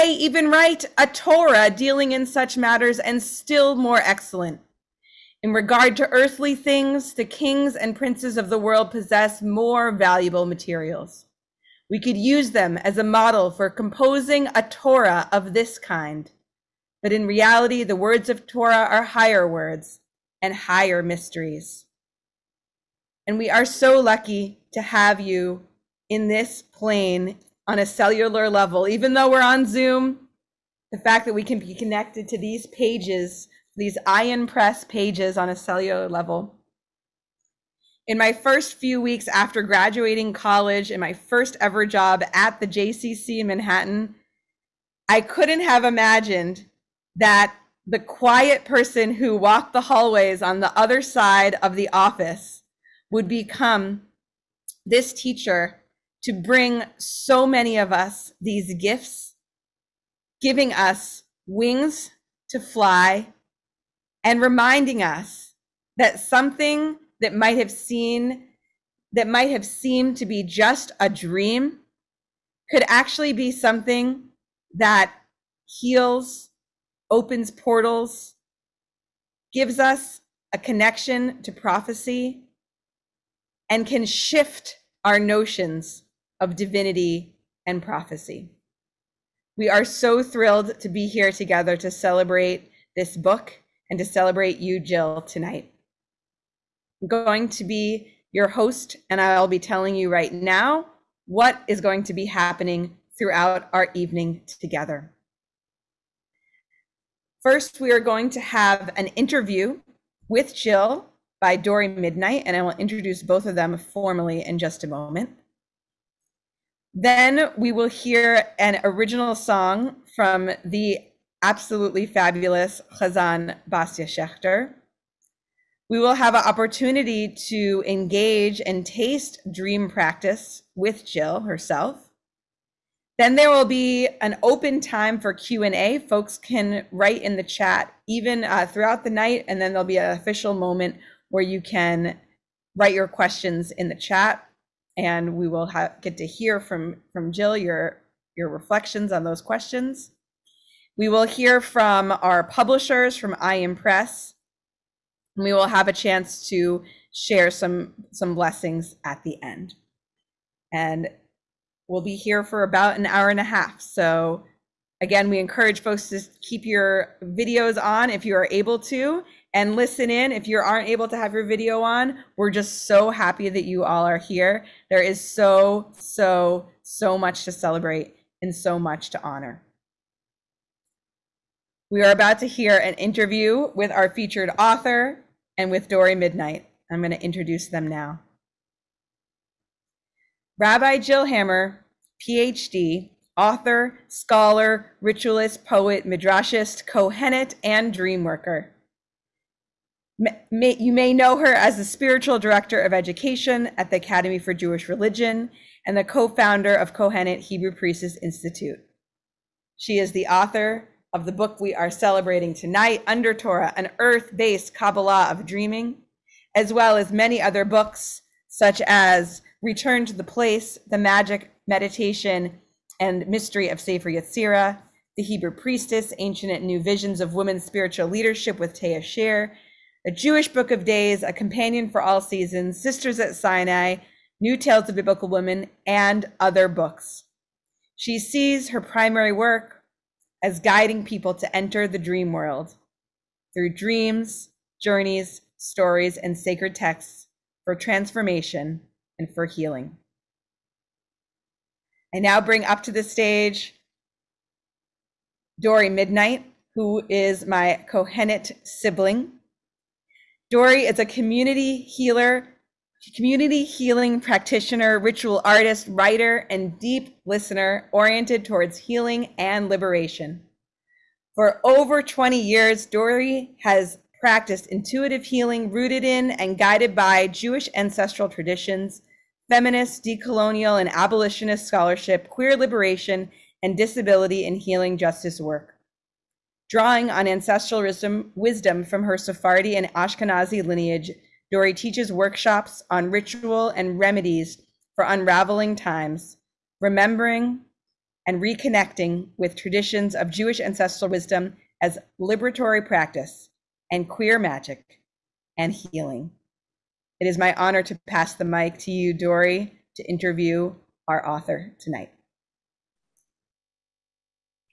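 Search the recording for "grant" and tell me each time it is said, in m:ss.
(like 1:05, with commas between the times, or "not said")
not said.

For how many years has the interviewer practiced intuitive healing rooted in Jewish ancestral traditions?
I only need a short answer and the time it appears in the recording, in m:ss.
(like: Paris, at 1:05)
over 20 years, at 4:31.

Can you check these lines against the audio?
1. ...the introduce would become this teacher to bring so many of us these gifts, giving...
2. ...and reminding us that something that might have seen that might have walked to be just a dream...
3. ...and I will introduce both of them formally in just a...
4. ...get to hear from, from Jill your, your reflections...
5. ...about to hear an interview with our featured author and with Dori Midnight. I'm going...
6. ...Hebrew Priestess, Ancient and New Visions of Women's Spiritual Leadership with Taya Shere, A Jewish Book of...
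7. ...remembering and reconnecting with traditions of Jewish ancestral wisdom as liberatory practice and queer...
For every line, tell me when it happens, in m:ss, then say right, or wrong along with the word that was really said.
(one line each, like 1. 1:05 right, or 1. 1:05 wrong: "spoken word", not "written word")
1. 0:51 wrong: "office", not "introduce"
2. 1:04 wrong: "seemed", not "walked"
3. 1:52 right
4. 2:26 right
5. 3:02 right
6. 3:45 right
7. 4:56 right.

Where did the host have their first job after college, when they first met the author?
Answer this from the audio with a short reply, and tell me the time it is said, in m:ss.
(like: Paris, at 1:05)
JCC in Manhattan, at 0:42.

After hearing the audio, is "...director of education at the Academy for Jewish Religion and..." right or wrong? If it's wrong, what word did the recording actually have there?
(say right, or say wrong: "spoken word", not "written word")
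right.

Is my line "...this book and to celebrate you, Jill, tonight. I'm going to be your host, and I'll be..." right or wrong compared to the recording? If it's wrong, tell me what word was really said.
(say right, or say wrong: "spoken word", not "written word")
right.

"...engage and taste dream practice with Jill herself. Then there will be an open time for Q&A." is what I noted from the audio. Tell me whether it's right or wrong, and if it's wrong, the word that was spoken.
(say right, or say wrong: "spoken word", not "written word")
right.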